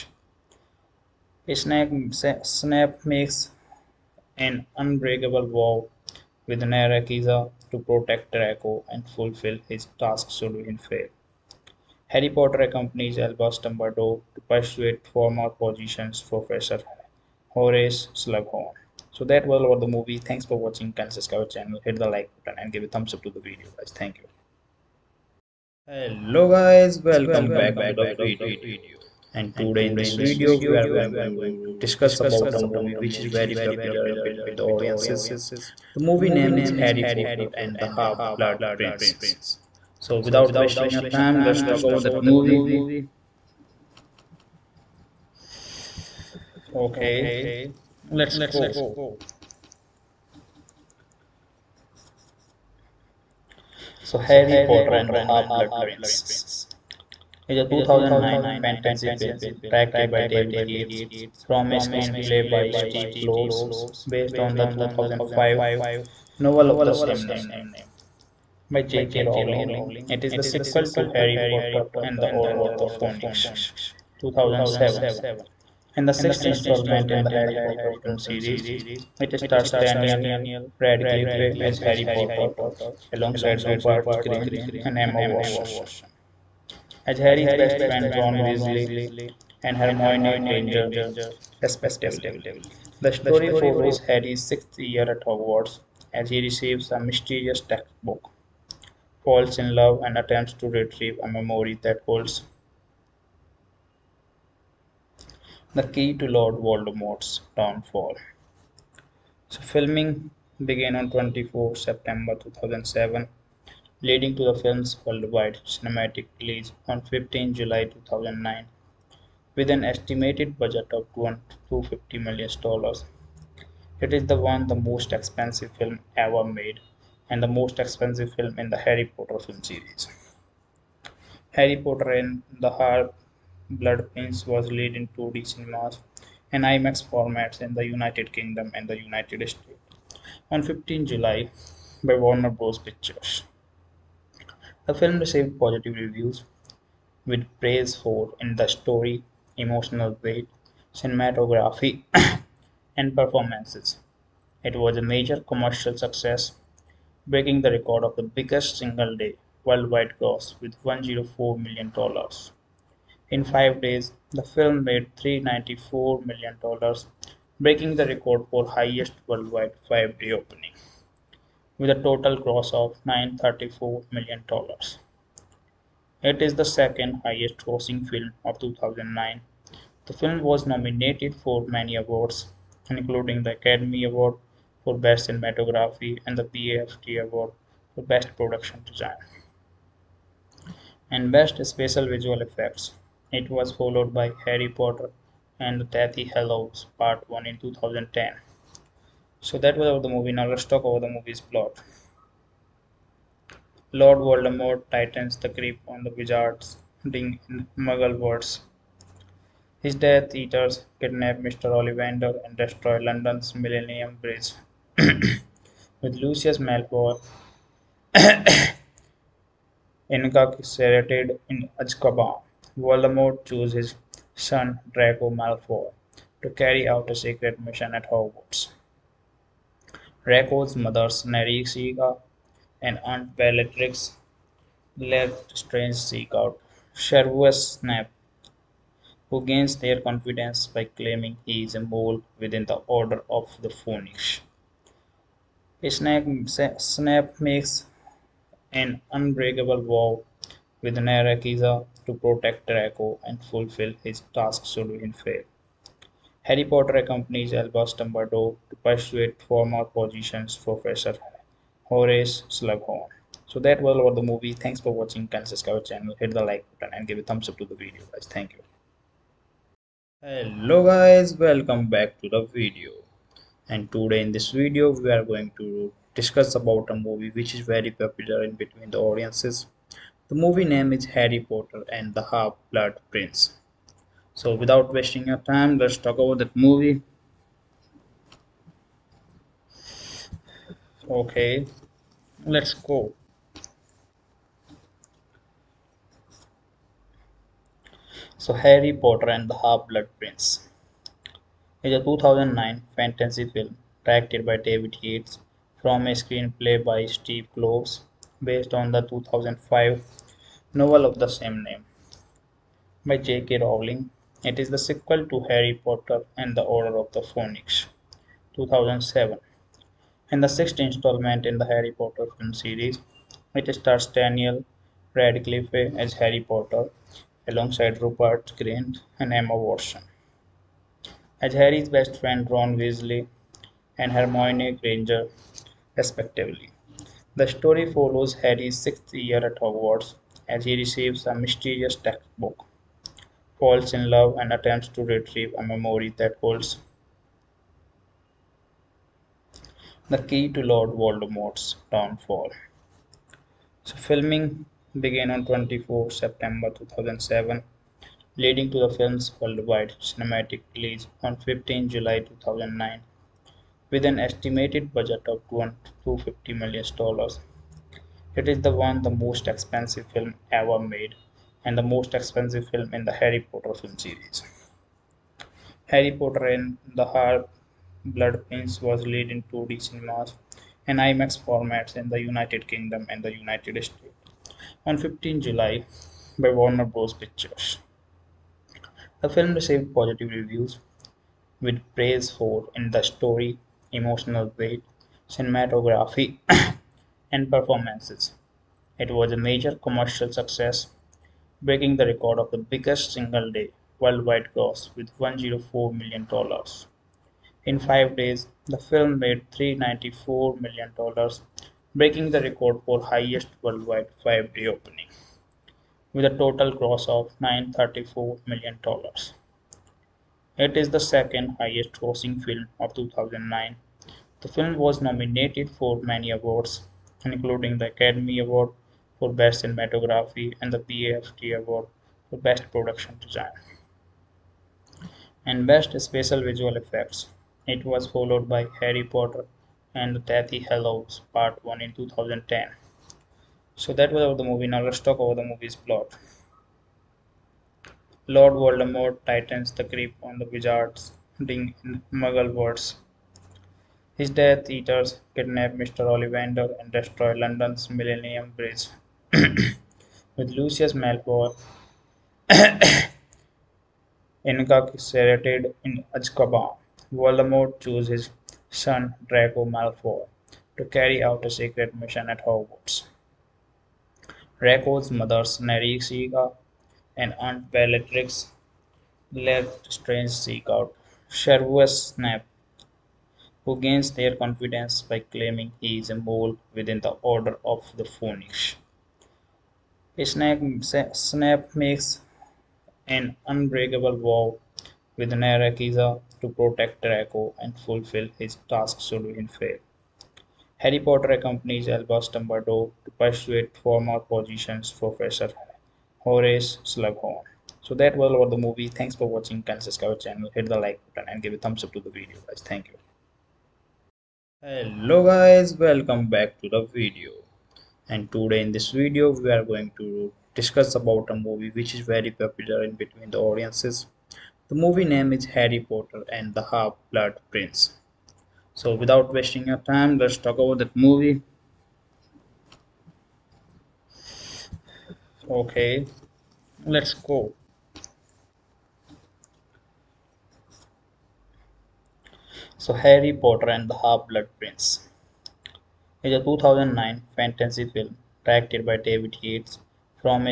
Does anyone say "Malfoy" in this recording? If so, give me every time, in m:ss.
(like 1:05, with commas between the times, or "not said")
3:36, 3:45, 7:40, 7:49.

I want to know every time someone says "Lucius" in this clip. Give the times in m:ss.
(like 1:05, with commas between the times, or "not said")
3:36, 7:40.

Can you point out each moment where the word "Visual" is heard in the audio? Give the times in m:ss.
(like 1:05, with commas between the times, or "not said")
3:12, 7:16.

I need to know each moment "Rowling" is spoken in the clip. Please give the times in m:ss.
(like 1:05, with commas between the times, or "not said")
1:09, 5:13.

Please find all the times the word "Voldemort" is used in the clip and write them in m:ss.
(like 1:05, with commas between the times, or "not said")
1:46, 3:24, 3:42, 5:50, 7:28, 7:47.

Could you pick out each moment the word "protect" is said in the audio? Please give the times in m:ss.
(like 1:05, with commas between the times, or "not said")
0:07, 4:12, 8:16.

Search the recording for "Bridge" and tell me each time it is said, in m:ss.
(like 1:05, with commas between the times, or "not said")
3:34, 7:38.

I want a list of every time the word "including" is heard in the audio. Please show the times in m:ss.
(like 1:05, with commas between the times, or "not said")
3:02, 7:07.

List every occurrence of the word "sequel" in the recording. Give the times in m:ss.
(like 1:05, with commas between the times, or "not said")
1:10, 5:14.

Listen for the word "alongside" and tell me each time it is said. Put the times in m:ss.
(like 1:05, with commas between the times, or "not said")
1:23, 5:27.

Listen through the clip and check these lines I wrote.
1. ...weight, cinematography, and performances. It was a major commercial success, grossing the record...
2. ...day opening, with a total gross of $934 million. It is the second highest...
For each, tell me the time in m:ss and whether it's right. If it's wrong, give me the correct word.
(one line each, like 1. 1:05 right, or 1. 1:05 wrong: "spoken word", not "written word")
1. 6:34 wrong: "breaking", not "grossing"
2. 6:54 right.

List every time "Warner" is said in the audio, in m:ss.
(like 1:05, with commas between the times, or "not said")
2:22, 6:26.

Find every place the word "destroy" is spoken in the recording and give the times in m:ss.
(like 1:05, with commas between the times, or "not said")
3:32, 7:36.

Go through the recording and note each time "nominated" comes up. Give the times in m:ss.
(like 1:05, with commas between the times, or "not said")
3:00, 7:05.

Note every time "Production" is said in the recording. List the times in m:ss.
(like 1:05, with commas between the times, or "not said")
3:08, 7:12.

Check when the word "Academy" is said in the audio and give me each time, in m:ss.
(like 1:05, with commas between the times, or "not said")
3:03, 7:07.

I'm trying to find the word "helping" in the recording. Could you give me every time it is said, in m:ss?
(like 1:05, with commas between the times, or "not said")
not said.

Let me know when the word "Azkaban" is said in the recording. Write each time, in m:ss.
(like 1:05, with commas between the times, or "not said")
3:41, 7:46.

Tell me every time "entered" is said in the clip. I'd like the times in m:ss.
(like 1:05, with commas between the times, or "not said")
not said.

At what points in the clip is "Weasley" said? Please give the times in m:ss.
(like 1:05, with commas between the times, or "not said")
1:28, 5:32.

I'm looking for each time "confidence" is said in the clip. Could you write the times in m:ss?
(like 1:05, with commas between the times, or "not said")
4:00, 8:04.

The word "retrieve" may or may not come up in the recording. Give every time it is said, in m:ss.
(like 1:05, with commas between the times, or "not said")
1:40, 5:45.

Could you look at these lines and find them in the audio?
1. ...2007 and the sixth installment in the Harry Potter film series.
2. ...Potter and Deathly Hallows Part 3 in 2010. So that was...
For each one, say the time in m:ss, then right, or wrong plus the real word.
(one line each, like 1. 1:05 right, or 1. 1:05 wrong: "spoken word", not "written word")
1. 1:14 right
2. 3:14 wrong: "1", not "3".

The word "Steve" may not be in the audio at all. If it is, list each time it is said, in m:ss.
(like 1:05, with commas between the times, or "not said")
1:02, 5:07.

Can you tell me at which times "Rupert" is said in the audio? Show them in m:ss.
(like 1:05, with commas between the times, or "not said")
1:23, 5:28.